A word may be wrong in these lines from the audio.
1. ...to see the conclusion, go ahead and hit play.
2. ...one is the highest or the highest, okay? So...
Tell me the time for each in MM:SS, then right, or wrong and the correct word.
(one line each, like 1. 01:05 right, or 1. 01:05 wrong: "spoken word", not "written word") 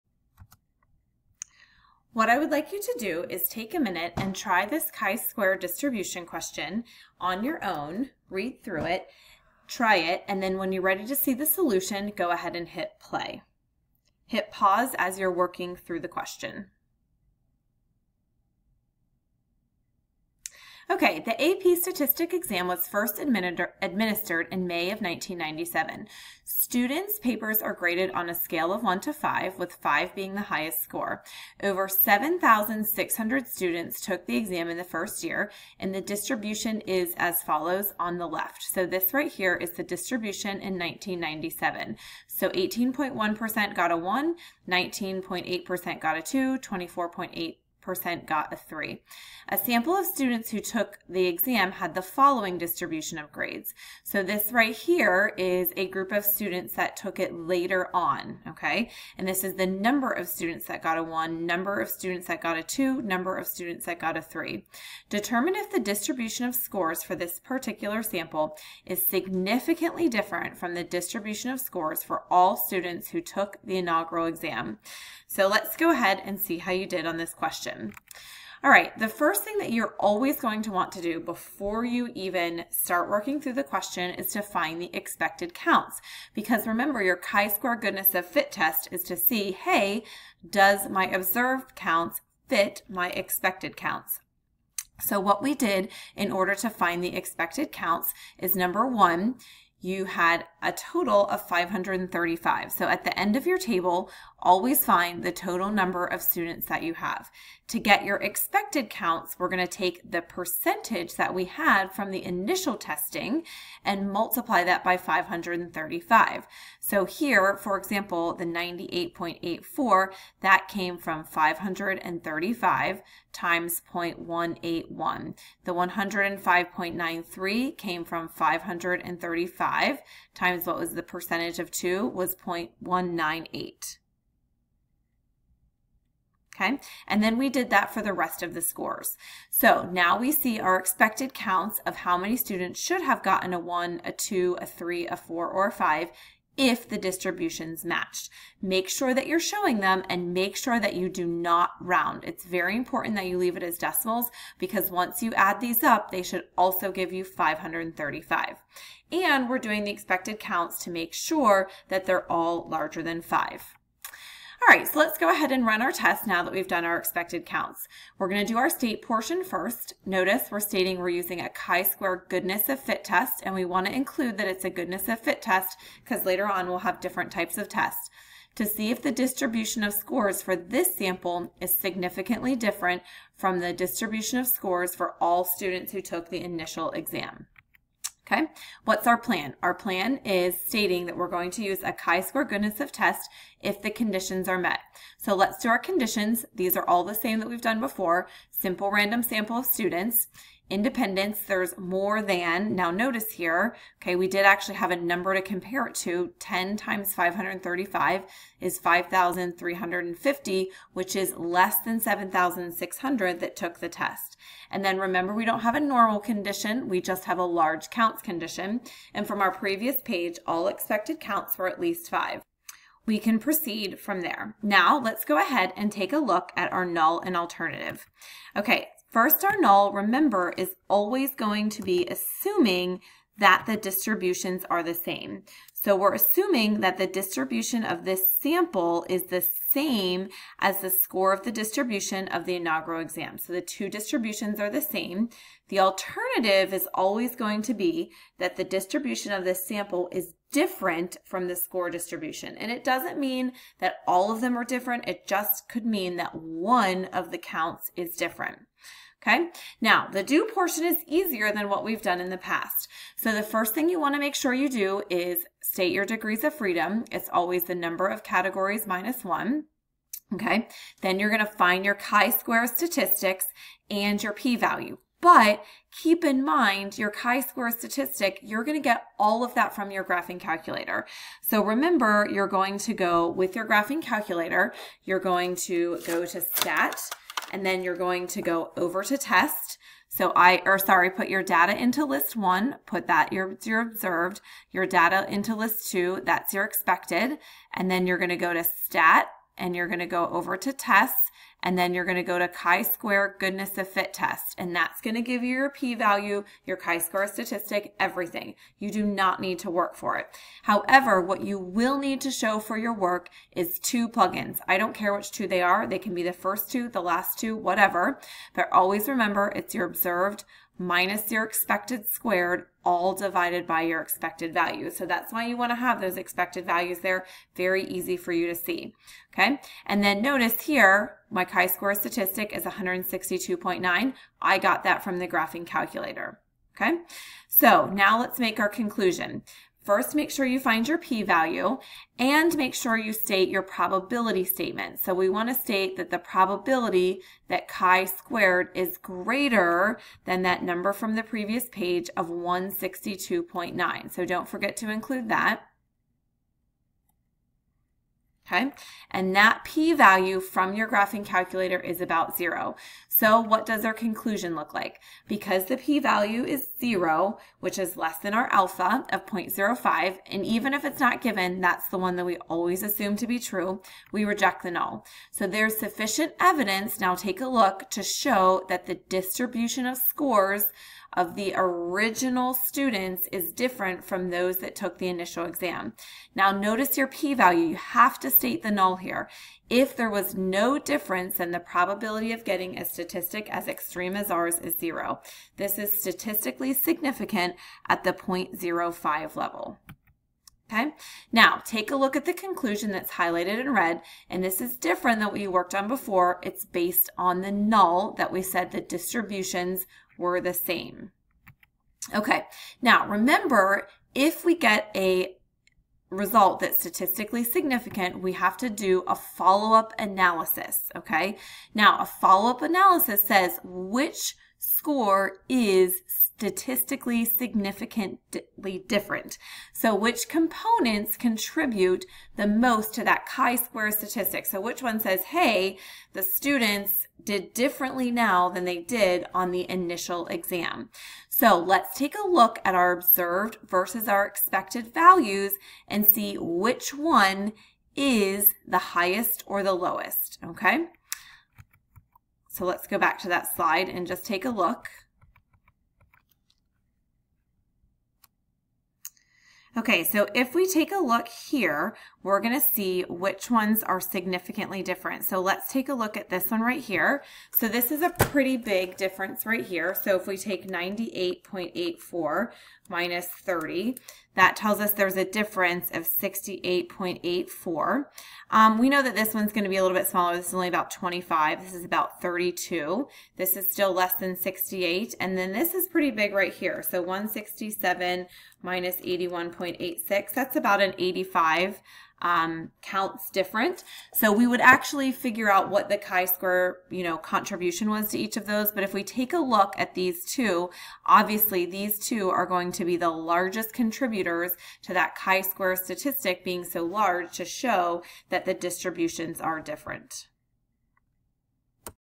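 1. 00:11 wrong: "solution", not "conclusion"
2. 07:26 wrong: "lowest", not "highest".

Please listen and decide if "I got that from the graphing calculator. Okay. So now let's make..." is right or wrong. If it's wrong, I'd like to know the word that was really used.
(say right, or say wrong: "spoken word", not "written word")
right.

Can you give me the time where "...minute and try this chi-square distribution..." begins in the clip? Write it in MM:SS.
00:03.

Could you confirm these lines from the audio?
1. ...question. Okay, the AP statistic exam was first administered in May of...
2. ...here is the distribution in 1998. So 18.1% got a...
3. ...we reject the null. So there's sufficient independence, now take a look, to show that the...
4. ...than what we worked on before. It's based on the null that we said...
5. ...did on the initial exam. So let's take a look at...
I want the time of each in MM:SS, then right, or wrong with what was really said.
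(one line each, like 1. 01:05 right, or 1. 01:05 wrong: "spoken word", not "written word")
1. 00:16 right
2. 00:39 wrong: "1997", not "1998"
3. 06:14 wrong: "evidence", not "independence"
4. 06:45 right
5. 07:18 right.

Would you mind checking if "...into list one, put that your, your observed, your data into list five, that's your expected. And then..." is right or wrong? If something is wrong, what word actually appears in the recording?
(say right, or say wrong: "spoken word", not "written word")
wrong: "two", not "five".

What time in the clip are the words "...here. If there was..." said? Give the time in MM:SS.
06:28.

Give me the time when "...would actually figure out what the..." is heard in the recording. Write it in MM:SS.
08:14.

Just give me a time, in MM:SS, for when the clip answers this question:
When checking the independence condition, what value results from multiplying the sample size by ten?
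03:28.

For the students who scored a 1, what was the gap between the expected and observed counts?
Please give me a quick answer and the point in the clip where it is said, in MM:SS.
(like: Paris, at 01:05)
68.84, at 07:56.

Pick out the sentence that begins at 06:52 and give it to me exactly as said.
Okay, now remember, if we get a result that's statistically significant, we have to do a follow-up analysis, okay?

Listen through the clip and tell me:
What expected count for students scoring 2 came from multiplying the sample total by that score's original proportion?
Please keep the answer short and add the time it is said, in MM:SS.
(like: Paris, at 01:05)
105.93, at 02:05.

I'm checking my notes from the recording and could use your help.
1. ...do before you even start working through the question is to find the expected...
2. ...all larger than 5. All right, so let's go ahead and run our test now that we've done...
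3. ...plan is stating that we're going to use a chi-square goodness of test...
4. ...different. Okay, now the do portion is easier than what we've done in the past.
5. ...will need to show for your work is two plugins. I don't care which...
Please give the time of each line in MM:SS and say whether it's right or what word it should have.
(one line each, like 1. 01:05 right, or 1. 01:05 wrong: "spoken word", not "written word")
1. 01:21 right
2. 02:42 right
3. 03:09 right
4. 04:18 right
5. 05:11 right.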